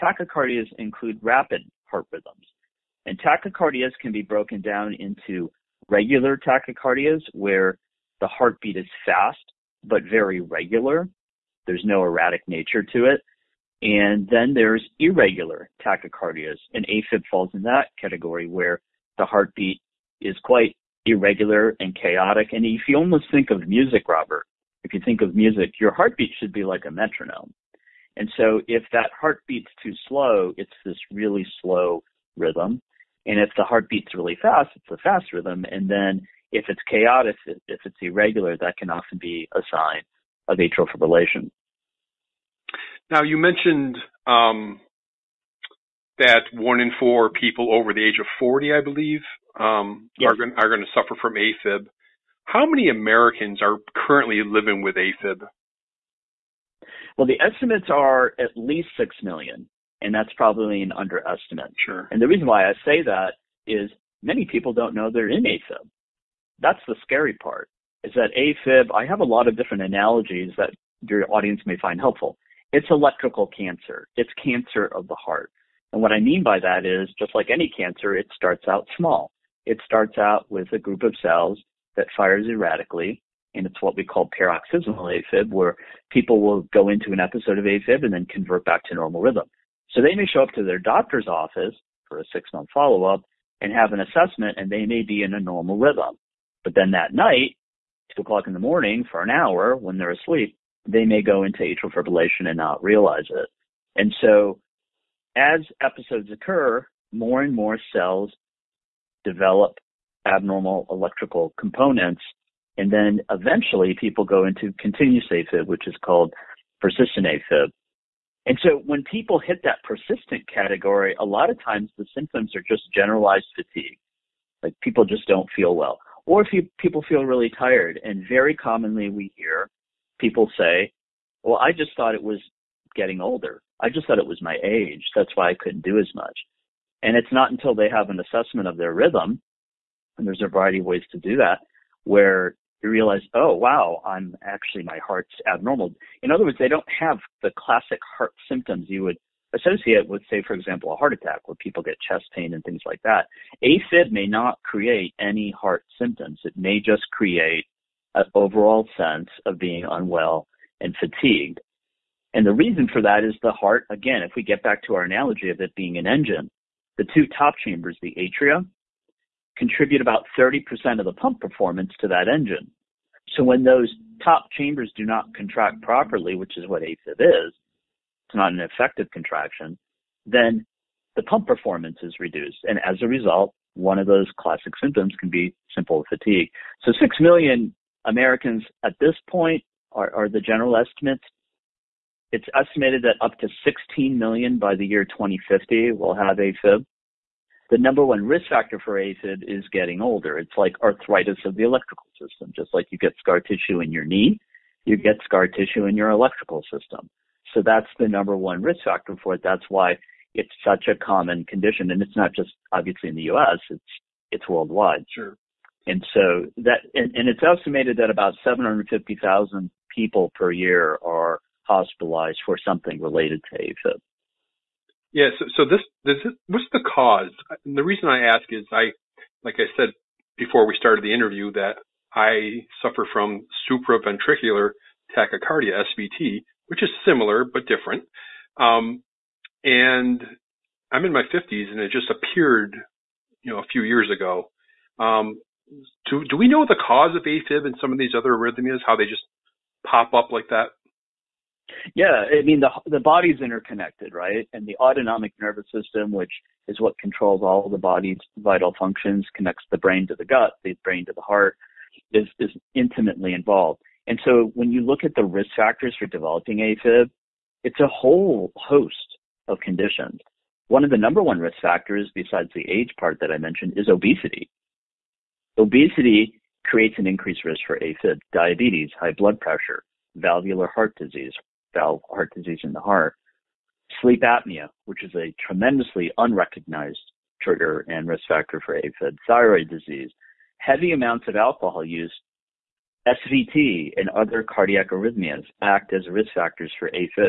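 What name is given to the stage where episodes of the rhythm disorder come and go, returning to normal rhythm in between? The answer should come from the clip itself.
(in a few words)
paroxysmal AFib.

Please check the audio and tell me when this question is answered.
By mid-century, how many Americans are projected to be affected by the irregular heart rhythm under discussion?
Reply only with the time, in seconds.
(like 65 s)
193 s.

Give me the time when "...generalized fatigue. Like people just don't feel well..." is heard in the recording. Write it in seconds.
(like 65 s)
122 s.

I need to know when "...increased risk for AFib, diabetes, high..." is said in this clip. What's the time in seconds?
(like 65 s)
277 s.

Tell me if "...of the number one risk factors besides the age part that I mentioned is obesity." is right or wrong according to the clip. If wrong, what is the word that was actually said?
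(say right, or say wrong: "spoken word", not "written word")
right.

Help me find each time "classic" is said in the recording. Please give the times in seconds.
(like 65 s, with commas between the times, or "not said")
147 s, 184 s.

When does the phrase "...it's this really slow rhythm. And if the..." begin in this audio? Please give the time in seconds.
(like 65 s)
30 s.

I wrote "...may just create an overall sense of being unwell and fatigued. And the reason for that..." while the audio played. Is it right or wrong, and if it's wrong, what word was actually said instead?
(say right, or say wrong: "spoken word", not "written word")
right.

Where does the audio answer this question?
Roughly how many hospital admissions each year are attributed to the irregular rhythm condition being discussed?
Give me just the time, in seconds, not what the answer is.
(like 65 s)
218 s.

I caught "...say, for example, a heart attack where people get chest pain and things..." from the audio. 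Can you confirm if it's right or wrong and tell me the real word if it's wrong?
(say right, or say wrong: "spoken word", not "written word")
right.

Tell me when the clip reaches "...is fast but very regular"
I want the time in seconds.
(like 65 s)
8 s.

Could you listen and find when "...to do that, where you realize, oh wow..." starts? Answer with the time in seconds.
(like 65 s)
141 s.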